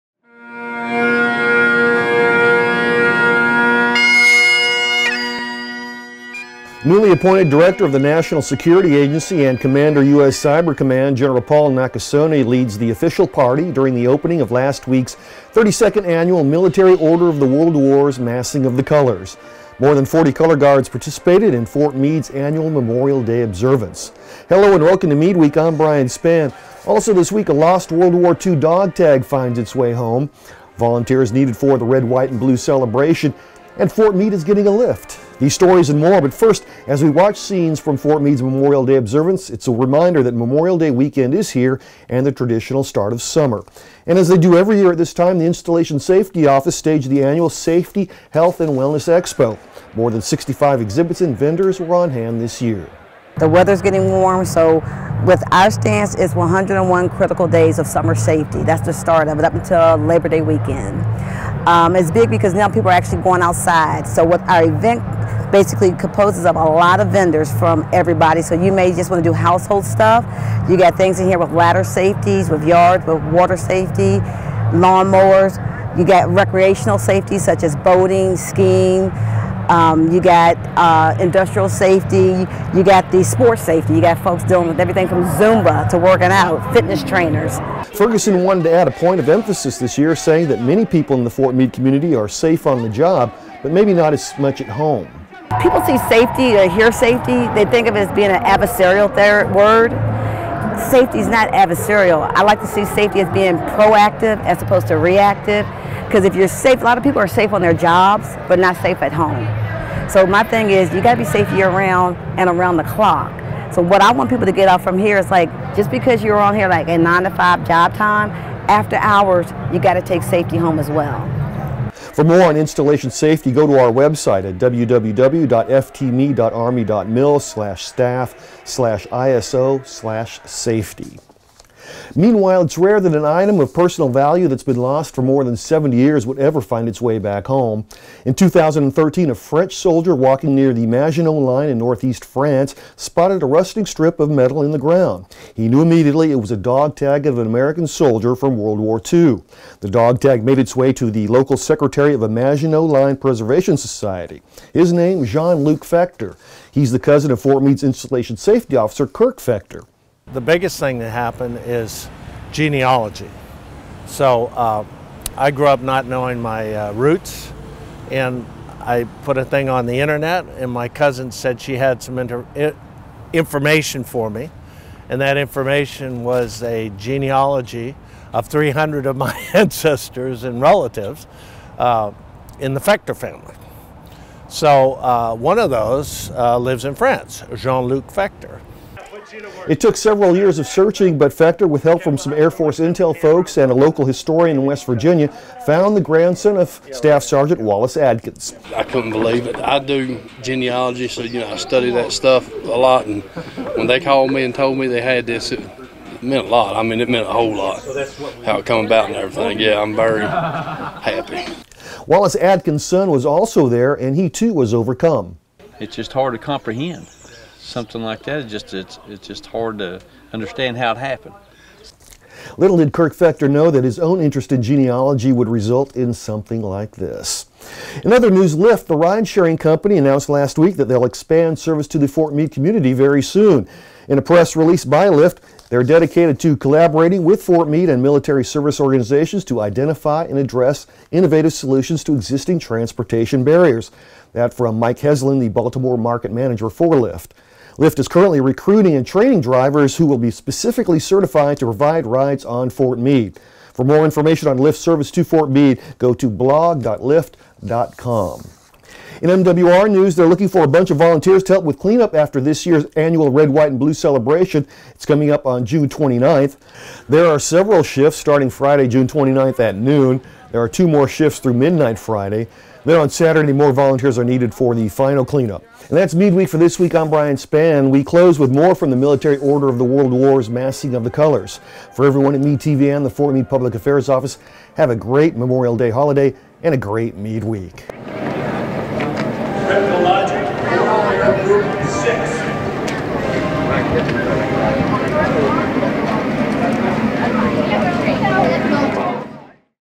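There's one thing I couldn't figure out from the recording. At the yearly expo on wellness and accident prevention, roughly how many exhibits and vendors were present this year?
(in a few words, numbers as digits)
More than 65.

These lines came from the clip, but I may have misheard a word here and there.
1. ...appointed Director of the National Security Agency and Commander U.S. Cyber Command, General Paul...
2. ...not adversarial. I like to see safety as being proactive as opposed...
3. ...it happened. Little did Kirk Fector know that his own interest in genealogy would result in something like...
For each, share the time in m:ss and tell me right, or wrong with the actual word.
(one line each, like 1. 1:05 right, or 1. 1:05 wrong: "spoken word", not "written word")
1. 0:07 right
2. 1:41 right
3. 3:40 right.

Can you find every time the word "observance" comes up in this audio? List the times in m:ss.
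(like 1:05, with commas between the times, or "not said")
0:23, 0:38.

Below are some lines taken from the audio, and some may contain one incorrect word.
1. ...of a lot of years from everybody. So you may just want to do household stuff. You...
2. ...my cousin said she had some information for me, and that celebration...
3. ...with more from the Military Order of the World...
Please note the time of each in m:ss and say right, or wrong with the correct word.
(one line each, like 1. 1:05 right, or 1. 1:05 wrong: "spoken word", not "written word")
1. 1:06 wrong: "vendors", not "years"
2. 2:50 wrong: "information", not "celebration"
3. 4:38 right.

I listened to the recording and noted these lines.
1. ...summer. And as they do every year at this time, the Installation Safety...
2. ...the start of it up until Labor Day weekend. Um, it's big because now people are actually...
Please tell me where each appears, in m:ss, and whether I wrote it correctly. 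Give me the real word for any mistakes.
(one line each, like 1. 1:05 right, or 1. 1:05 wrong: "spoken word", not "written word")
1. 0:43 right
2. 0:58 right.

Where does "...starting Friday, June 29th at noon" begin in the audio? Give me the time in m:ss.
4:28.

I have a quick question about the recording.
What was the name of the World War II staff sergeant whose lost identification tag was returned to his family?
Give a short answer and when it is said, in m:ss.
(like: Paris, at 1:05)
Wallace Adkins, at 3:17.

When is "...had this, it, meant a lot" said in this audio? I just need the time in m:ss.
3:25.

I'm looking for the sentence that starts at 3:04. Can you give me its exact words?
So uh, one of those uh, lives in France, Jean-Luc Fector.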